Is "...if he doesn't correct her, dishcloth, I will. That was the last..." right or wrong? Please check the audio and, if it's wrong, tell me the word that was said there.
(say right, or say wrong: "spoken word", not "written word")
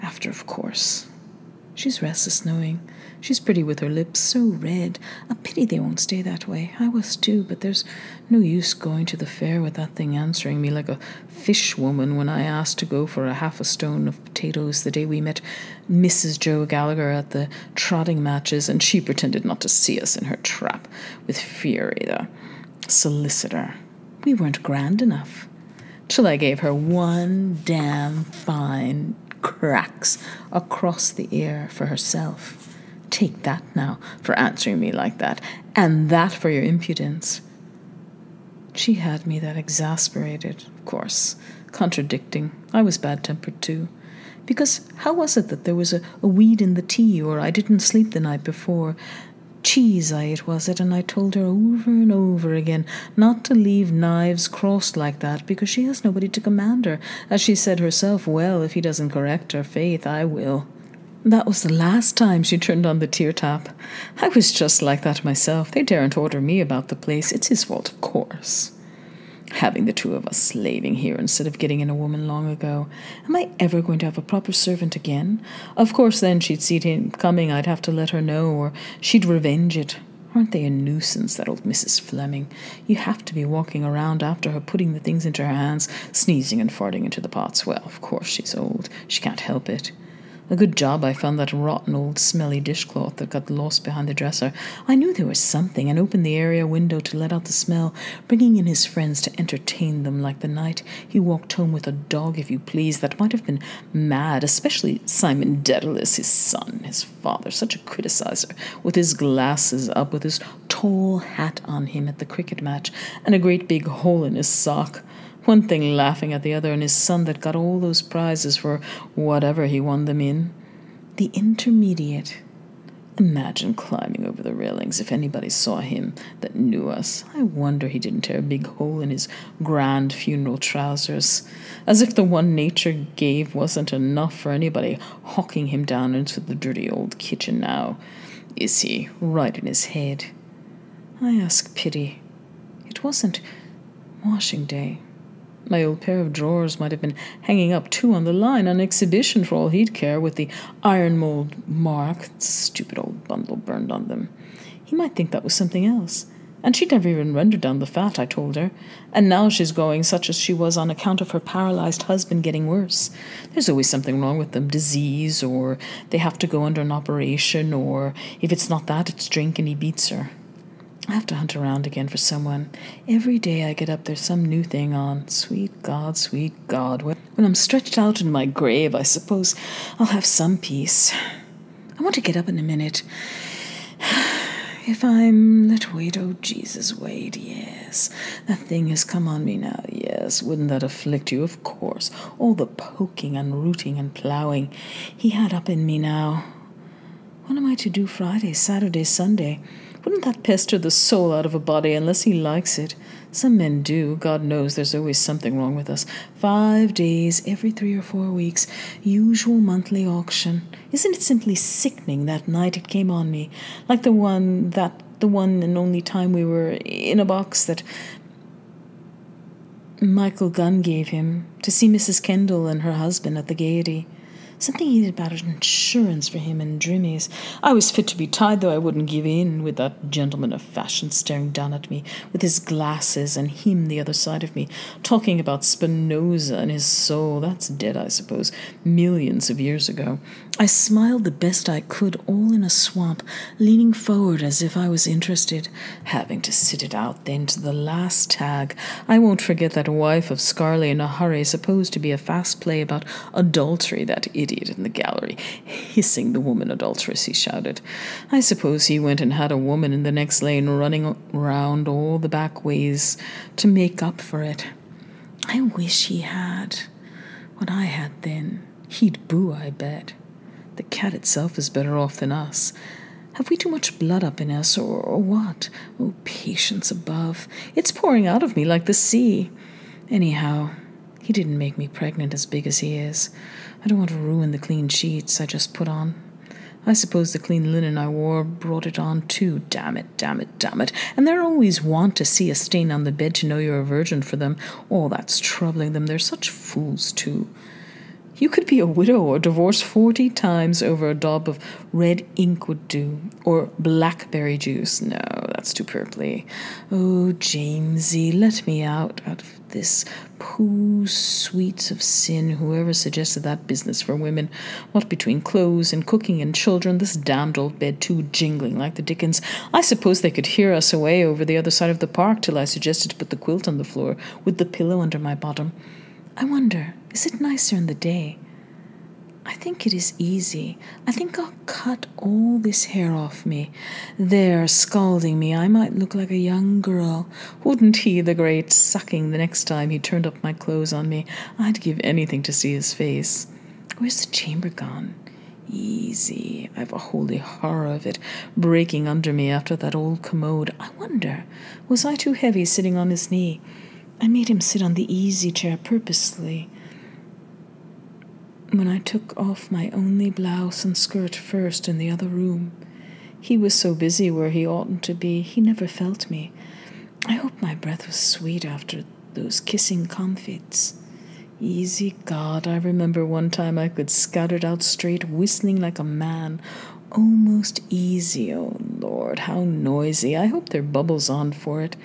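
wrong: "faith", not "dishcloth".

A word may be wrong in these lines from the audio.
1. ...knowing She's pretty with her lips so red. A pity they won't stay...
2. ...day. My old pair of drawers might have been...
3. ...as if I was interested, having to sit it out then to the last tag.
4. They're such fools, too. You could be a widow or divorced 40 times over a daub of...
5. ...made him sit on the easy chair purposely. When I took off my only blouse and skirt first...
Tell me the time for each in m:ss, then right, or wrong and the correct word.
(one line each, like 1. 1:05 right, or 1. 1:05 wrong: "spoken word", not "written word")
1. 0:02 right
2. 2:24 right
3. 4:04 right
4. 4:56 right
5. 5:54 right.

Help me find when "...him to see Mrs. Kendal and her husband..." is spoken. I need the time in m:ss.
3:41.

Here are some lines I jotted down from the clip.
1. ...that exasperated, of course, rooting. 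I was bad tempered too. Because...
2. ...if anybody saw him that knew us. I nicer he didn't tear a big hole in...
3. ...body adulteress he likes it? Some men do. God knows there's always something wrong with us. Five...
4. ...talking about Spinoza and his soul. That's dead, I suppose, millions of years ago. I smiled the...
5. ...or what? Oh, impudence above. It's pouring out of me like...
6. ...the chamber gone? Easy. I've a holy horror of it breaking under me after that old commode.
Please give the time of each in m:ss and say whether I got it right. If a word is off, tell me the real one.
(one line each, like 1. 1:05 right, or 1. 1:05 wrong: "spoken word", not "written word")
1. 0:39 wrong: "contradicting", not "rooting"
2. 2:04 wrong: "wonder", not "nicer"
3. 3:21 wrong: "unless", not "adulteress"
4. 3:55 right
5. 4:35 wrong: "patience", not "impudence"
6. 5:44 right.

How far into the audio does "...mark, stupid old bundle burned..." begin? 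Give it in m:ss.
2:31.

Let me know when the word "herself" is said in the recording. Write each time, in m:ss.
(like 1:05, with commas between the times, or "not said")
0:31, 0:57.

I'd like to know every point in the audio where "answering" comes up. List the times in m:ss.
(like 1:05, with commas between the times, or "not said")
0:10, 0:34.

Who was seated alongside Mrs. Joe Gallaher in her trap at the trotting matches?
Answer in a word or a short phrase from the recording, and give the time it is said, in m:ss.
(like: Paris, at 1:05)
Friery, the solicitor, at 0:21.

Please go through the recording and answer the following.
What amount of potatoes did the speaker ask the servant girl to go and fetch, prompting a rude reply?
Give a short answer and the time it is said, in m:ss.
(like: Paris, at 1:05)
half a stone, at 0:13.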